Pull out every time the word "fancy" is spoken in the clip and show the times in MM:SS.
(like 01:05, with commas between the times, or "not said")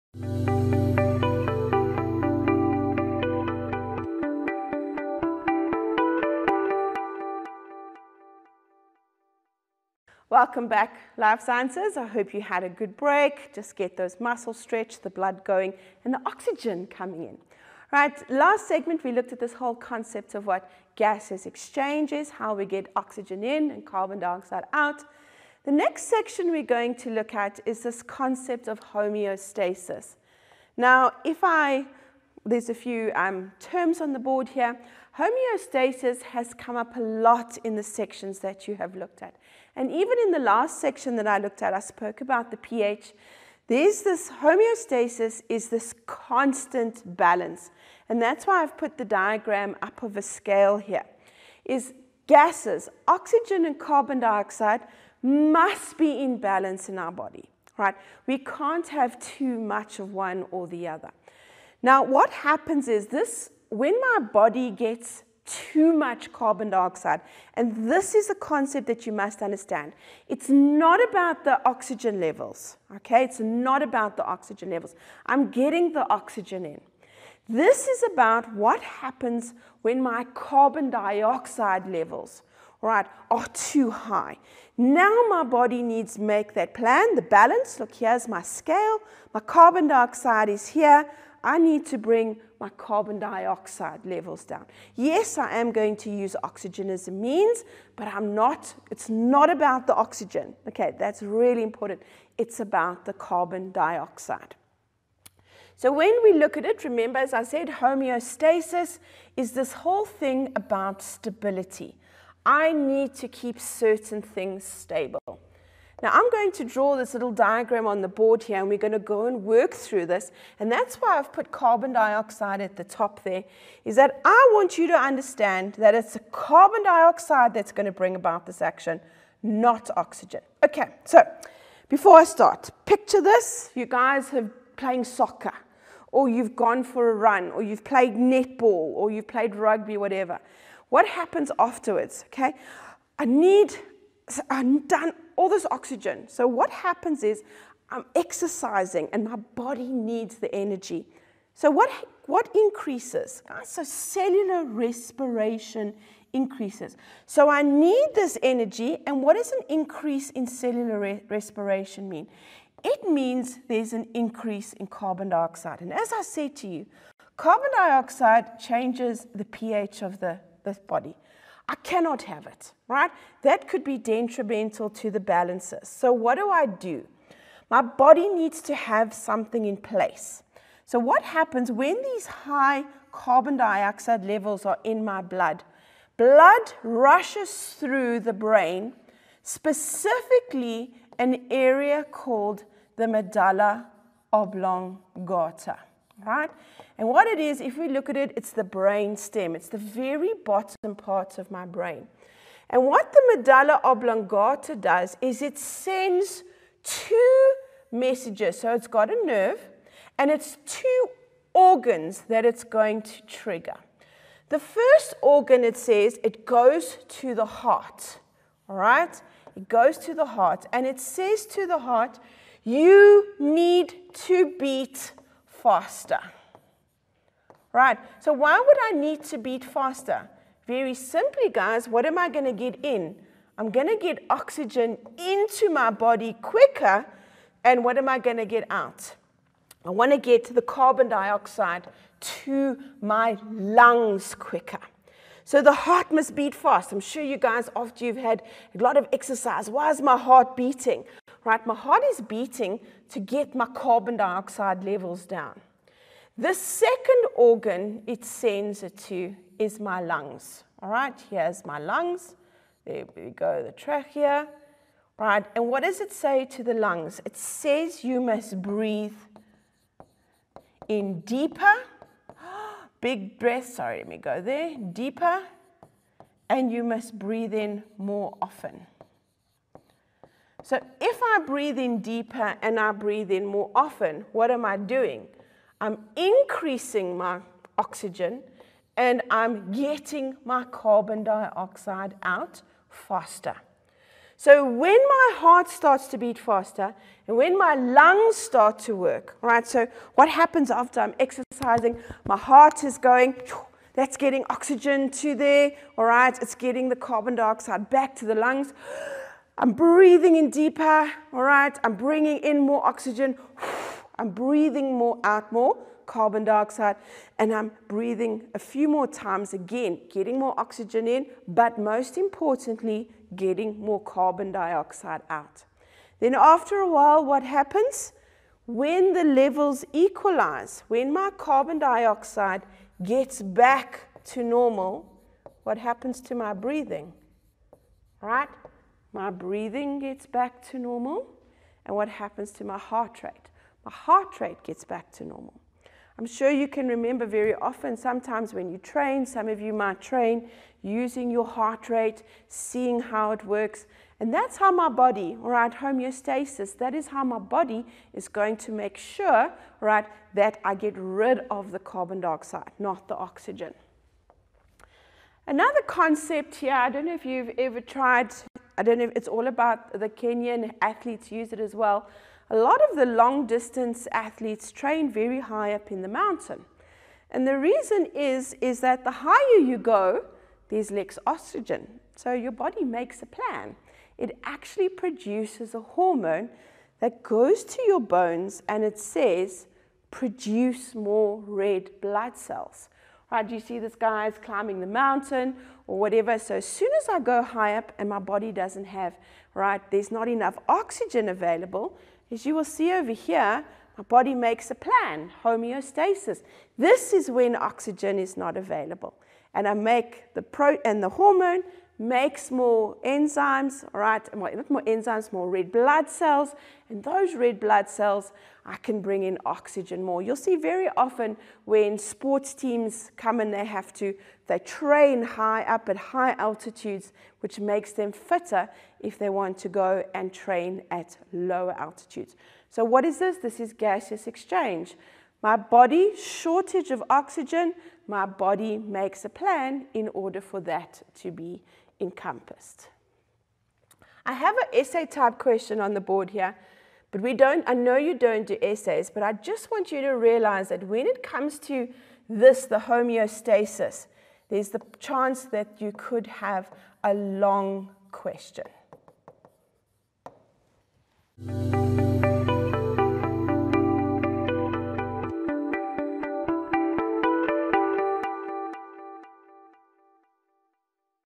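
not said.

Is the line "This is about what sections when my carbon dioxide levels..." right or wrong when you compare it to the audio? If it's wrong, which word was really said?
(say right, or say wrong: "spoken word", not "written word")
wrong: "happens", not "sections".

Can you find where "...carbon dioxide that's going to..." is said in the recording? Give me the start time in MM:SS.
02:06.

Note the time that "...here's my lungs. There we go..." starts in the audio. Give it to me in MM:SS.
04:21.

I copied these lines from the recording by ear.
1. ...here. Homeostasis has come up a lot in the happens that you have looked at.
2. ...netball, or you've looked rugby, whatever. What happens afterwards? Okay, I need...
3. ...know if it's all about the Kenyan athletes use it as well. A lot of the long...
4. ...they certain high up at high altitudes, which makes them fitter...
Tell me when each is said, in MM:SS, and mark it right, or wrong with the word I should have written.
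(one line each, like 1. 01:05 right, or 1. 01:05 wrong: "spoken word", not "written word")
1. 00:34 wrong: "sections", not "happens"
2. 02:18 wrong: "played", not "looked"
3. 06:08 right
4. 07:04 wrong: "train", not "certain".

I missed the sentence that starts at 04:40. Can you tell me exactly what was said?
So if I breathe in deeper and I breathe in more often, what am I doing?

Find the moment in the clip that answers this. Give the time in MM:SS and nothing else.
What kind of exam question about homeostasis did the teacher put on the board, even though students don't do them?
07:24.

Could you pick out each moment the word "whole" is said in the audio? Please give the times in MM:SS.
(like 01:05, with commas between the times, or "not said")
00:19, 01:49.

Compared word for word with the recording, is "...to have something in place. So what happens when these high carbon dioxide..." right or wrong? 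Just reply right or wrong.
right.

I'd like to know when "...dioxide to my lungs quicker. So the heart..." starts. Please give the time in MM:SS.
04:01.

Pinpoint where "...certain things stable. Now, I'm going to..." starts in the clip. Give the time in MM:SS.
01:53.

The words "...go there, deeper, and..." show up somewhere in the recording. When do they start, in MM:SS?
04:34.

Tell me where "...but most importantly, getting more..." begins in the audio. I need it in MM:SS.
05:21.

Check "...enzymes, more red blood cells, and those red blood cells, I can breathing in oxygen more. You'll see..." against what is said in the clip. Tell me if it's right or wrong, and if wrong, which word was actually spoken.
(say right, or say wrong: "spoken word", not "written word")
wrong: "bring", not "breathing".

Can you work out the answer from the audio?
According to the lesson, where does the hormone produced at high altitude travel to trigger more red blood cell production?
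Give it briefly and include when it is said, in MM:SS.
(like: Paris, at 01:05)
Bones, at 06:27.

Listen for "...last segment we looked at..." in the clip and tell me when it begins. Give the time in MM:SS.
00:18.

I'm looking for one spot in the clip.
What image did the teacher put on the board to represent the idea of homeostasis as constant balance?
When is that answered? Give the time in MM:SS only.
00:50.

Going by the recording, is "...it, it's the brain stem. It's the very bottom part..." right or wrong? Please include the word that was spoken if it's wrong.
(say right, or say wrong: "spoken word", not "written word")
right.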